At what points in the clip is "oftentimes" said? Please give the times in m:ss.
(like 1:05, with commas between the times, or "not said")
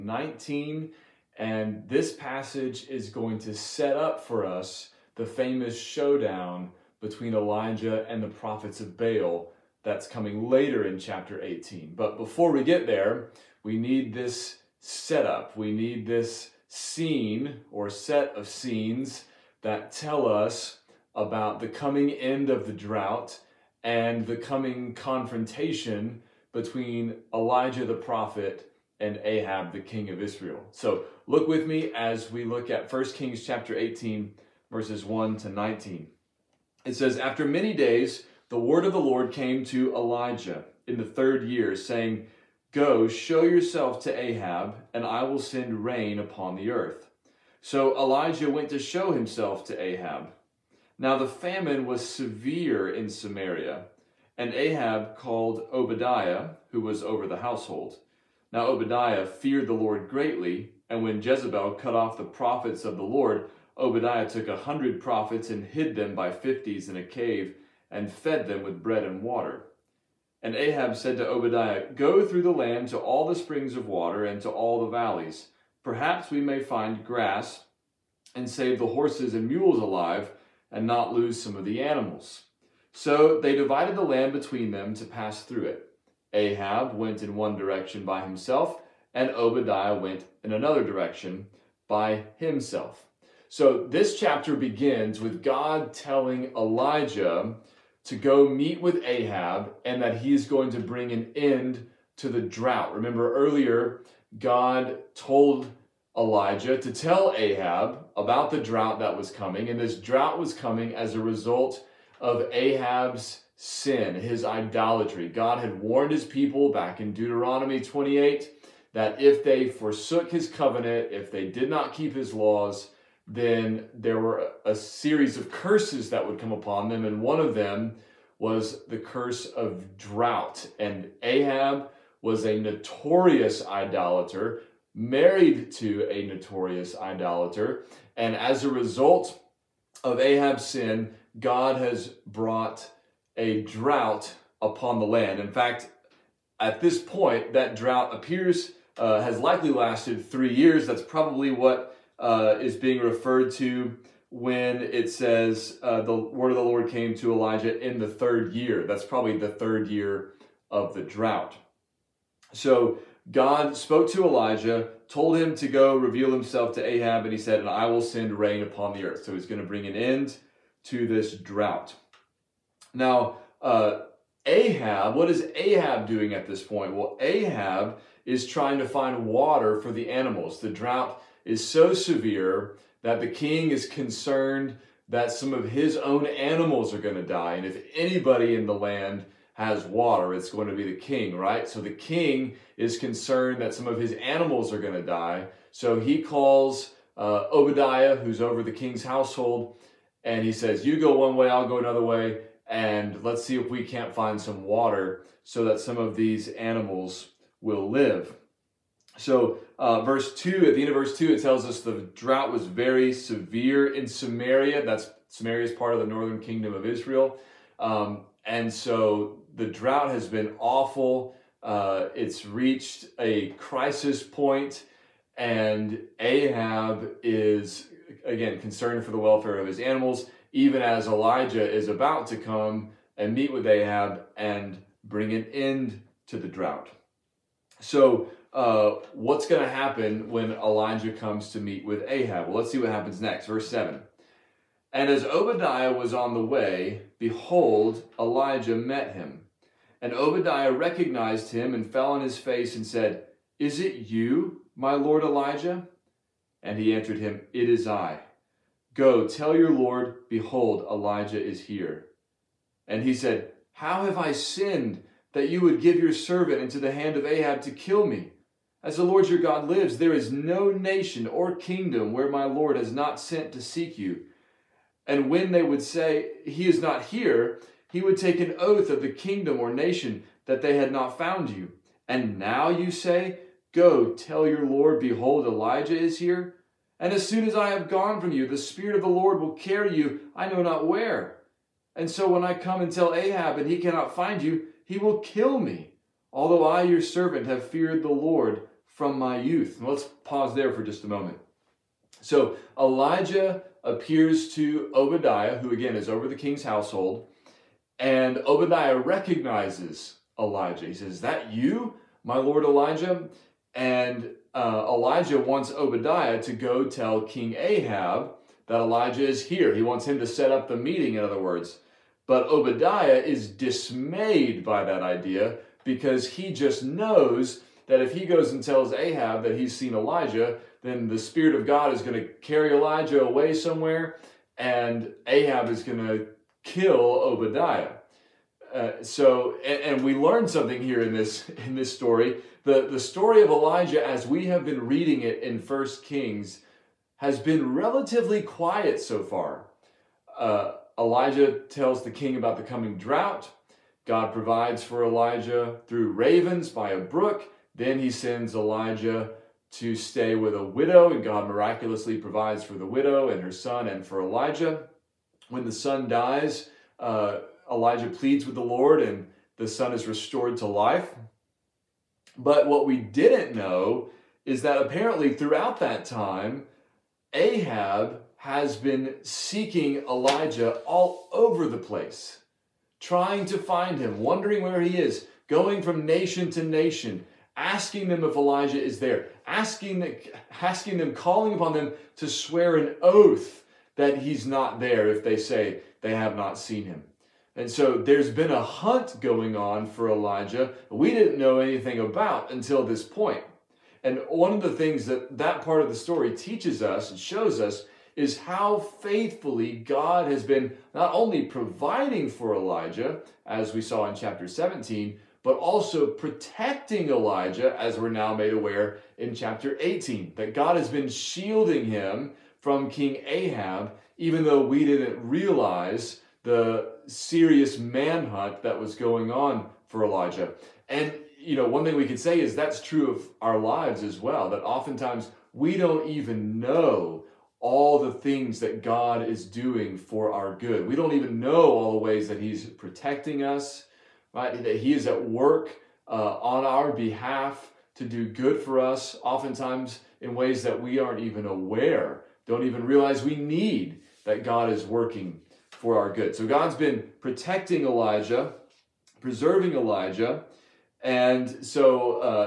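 7:14, 7:29.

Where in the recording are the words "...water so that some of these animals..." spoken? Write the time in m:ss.
3:24.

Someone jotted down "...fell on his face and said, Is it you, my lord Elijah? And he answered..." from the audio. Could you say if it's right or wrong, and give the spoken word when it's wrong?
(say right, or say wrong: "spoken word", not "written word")
right.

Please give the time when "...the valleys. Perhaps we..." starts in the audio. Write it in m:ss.
1:14.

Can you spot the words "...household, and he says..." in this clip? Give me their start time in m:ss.
3:19.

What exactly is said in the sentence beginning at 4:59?
let's pause there for just a moment.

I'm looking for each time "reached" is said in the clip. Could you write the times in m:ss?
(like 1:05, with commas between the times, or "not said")
3:42.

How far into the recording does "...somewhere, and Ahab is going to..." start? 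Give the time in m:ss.
5:33.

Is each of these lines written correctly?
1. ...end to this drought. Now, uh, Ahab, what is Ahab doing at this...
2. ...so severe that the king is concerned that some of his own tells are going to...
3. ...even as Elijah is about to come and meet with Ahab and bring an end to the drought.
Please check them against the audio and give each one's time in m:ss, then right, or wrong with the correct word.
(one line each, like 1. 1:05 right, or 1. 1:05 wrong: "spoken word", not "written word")
1. 2:49 right
2. 3:01 wrong: "animals", not "tells"
3. 3:50 right.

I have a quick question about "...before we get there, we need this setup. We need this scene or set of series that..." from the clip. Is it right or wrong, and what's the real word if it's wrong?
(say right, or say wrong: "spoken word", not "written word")
wrong: "scenes", not "series".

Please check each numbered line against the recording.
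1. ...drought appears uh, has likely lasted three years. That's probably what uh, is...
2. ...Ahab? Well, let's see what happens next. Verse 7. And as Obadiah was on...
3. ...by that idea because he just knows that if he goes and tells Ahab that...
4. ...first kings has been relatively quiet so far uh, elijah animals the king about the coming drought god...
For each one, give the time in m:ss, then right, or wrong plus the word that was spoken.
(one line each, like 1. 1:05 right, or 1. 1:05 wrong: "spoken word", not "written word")
1. 2:27 right
2. 4:02 right
3. 5:24 right
4. 5:45 wrong: "tells", not "animals".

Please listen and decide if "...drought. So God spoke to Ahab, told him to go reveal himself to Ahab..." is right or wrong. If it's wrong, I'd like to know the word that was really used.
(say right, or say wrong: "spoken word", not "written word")
wrong: "Elijah", not "Ahab".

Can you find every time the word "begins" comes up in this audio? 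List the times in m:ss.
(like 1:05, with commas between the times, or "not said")
1:34.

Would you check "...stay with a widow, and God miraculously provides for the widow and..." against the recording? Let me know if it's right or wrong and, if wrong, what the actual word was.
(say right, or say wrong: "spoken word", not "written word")
right.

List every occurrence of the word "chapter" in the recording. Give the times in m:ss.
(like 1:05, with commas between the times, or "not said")
0:10, 0:33, 1:34, 6:54, 6:59.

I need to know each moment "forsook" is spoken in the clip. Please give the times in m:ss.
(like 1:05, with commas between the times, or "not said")
1:59.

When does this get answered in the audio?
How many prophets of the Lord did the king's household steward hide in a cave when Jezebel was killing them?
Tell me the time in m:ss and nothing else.
1:04.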